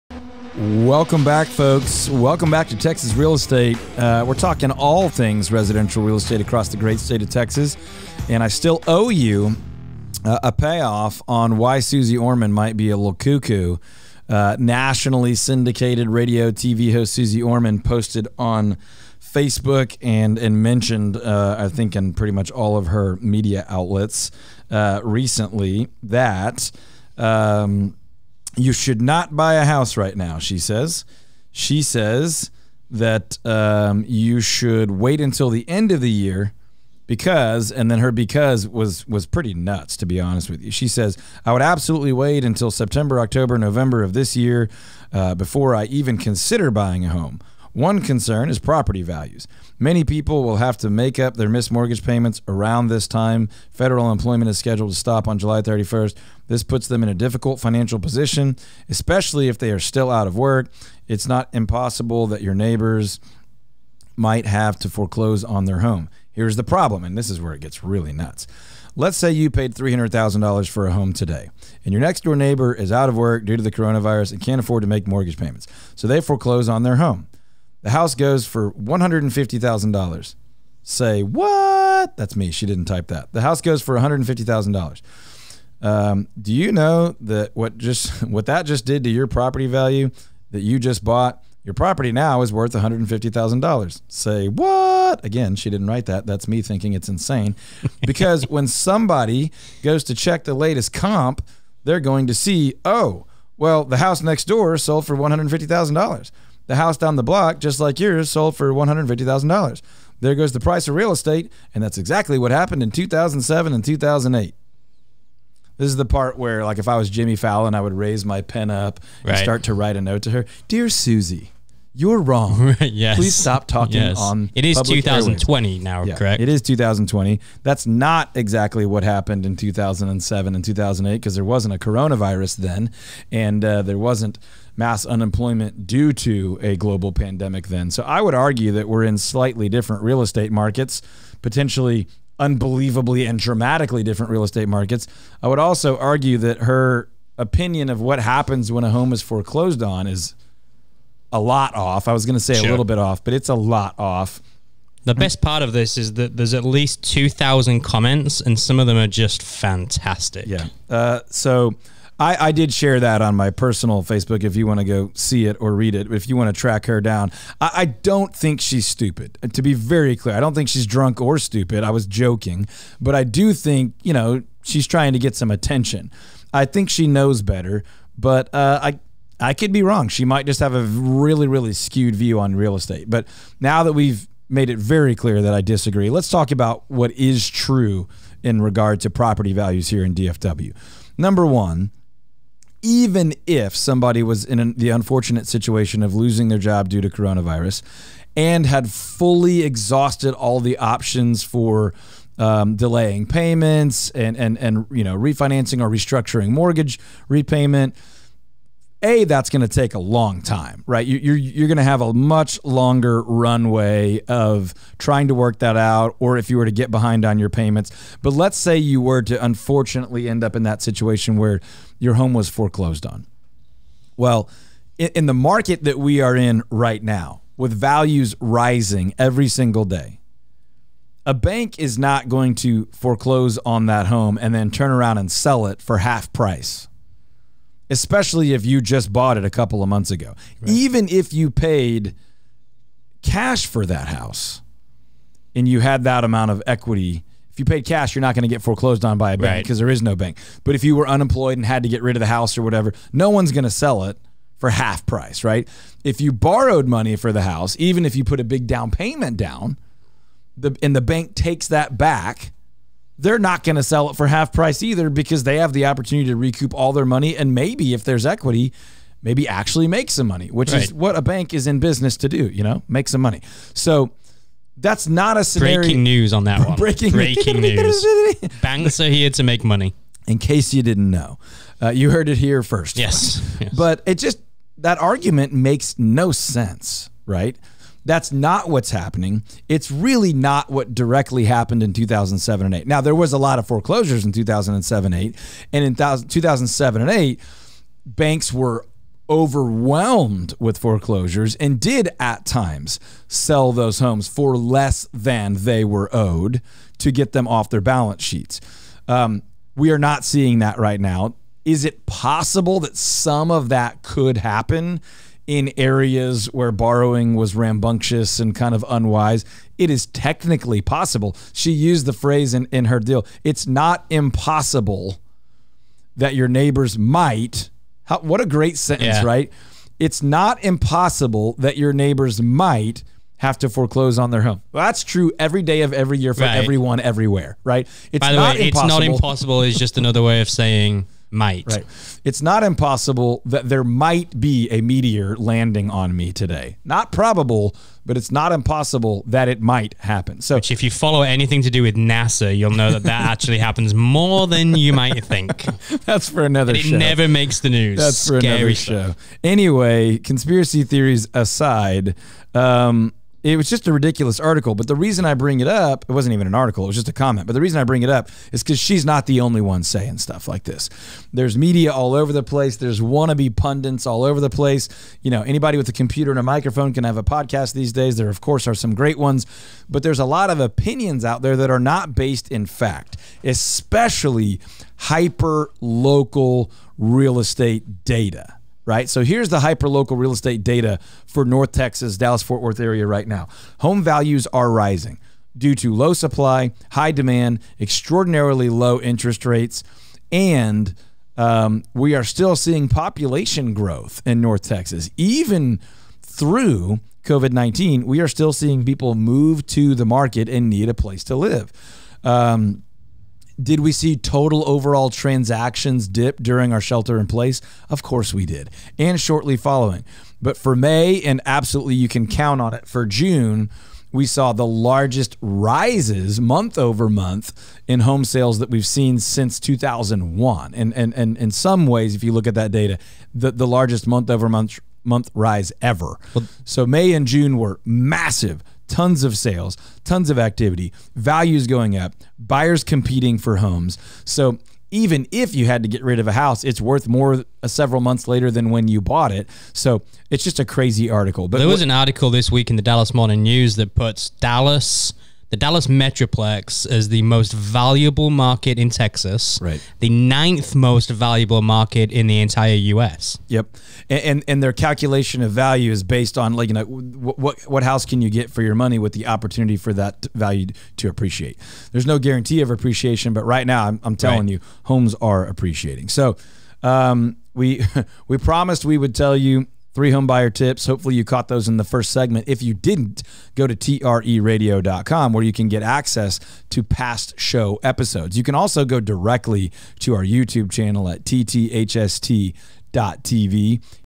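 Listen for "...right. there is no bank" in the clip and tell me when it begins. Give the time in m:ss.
4:09.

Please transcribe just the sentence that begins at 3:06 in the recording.
Let's talk about what is true in regard to property values here in DFW.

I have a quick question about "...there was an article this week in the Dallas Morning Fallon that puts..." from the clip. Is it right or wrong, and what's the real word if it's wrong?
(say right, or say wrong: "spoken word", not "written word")
wrong: "News", not "Fallon".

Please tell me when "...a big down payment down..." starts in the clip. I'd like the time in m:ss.
4:18.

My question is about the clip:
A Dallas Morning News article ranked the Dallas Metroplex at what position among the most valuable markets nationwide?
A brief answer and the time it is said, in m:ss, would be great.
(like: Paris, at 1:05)
ninth, at 7:40.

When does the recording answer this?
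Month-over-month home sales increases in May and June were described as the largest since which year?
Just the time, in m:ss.
7:09.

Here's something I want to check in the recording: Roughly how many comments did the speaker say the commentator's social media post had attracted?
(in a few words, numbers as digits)
2,000.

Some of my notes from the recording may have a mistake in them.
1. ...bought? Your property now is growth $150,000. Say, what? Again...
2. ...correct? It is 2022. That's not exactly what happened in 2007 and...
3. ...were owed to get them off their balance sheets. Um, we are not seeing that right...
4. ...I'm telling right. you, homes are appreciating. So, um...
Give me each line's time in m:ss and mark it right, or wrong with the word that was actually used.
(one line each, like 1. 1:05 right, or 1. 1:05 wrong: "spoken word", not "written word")
1. 1:31 wrong: "worth", not "growth"
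2. 2:06 wrong: "2020", not "2022"
3. 5:05 right
4. 7:54 right.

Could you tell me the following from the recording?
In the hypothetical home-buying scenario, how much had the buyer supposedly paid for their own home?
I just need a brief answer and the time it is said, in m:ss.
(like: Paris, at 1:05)
$300,000, at 1:09.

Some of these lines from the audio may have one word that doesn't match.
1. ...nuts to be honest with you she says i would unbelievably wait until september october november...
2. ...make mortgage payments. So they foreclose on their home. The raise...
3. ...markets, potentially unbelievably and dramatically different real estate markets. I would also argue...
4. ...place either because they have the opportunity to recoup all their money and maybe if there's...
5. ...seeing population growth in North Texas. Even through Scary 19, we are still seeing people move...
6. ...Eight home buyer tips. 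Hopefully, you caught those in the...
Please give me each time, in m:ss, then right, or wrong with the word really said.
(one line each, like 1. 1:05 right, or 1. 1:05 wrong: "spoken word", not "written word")
1. 0:39 wrong: "absolutely", not "unbelievably"
2. 1:14 wrong: "house", not "raise"
3. 2:20 right
4. 4:24 wrong: "price", not "place"
5. 6:42 wrong: "COVID", not "Scary"
6. 7:59 wrong: "Three", not "Eight".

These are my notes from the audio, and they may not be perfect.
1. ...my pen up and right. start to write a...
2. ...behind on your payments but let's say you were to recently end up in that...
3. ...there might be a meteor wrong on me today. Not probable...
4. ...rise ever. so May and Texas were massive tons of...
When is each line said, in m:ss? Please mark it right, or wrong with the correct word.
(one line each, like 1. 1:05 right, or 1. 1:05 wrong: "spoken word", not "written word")
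1. 1:58 right
2. 3:36 wrong: "unfortunately", not "recently"
3. 5:43 wrong: "landing", not "wrong"
4. 7:15 wrong: "June", not "Texas".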